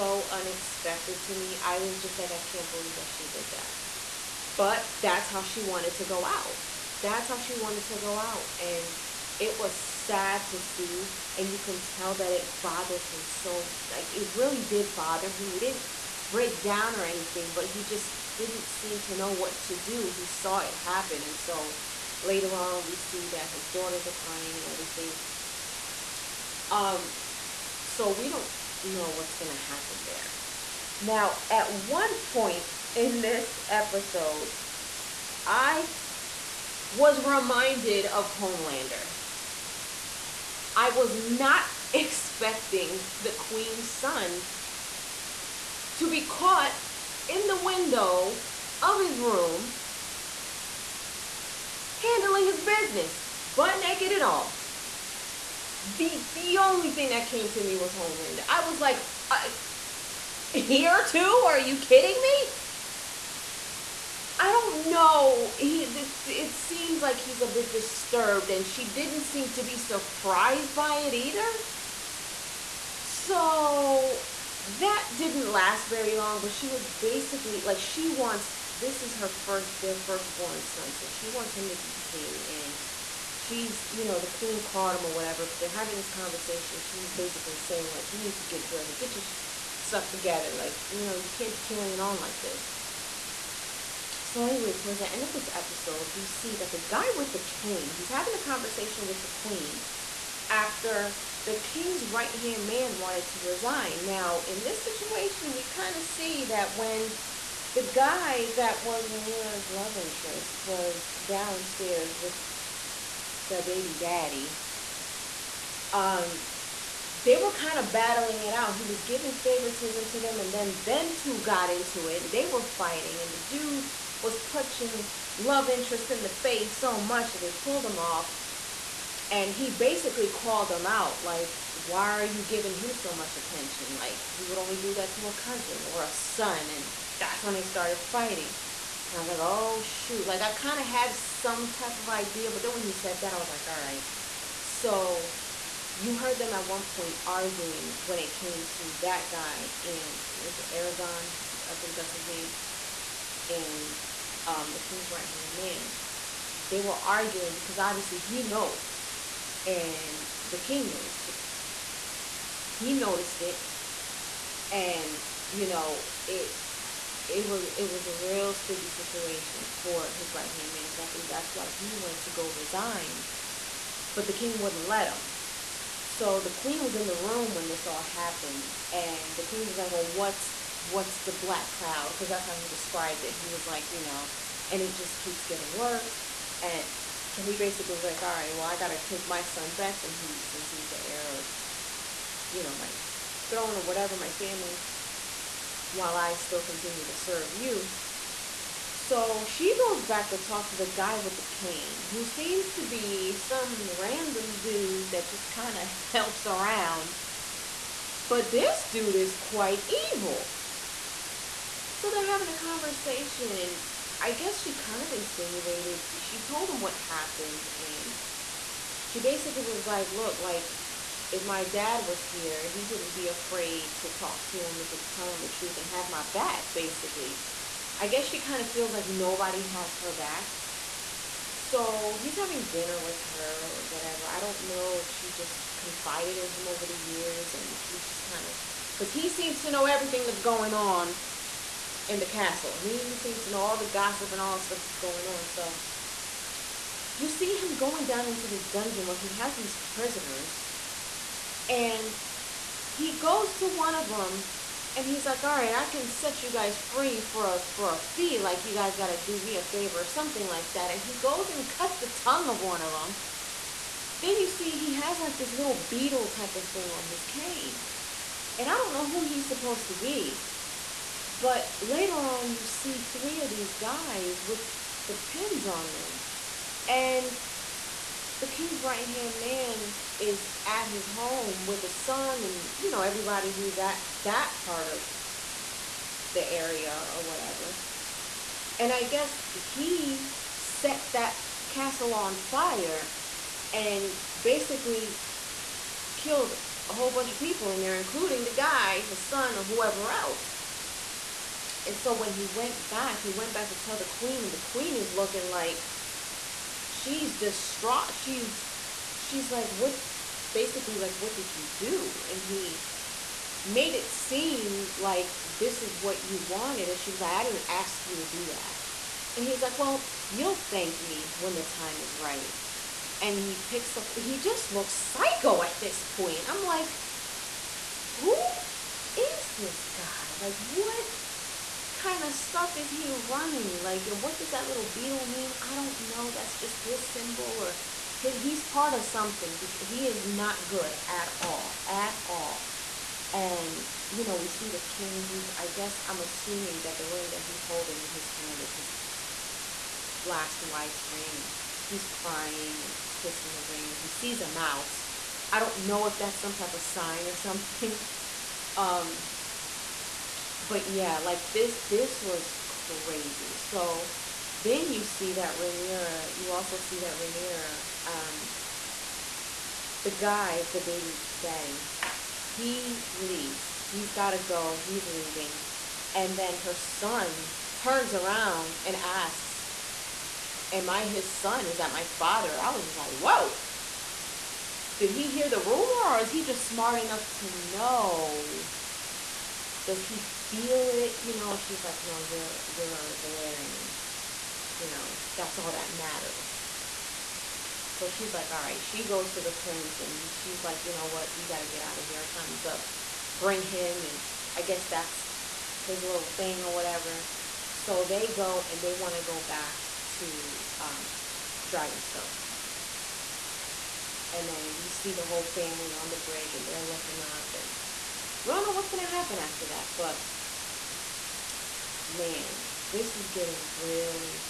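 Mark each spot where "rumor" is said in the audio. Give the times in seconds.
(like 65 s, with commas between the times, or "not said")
385 s.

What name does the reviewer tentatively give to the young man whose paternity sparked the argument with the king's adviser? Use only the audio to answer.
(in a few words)
Aragon.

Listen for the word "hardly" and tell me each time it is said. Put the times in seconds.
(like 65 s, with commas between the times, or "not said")
not said.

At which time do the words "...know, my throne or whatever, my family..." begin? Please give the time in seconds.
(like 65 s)
192 s.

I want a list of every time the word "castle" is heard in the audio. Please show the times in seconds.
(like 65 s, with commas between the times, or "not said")
242 s, 291 s.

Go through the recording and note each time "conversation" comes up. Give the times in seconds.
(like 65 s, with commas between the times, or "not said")
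86 s, 98 s, 212 s.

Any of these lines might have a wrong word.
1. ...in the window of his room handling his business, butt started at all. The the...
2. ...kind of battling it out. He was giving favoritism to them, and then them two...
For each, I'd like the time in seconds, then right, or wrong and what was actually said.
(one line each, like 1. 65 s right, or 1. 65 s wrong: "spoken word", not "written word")
1. 47 s wrong: "naked", not "started"
2. 117 s right.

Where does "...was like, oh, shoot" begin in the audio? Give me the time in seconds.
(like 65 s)
139 s.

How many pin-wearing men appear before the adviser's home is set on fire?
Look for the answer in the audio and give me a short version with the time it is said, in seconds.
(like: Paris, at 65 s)
3, at 273 s.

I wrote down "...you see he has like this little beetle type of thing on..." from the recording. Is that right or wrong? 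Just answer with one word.
right.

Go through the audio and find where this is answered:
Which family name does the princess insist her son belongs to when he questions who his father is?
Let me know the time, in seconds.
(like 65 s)
393 s.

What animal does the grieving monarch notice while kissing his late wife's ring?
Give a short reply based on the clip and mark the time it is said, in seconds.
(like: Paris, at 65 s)
mouse, at 354 s.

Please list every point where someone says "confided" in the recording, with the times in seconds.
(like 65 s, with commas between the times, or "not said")
235 s.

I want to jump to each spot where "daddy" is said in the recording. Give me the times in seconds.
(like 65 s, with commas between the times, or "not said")
113 s, 371 s.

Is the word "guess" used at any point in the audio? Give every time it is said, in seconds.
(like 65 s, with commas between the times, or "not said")
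214 s, 228 s, 289 s, 345 s, 404 s.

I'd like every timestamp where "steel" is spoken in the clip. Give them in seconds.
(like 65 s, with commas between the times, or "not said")
not said.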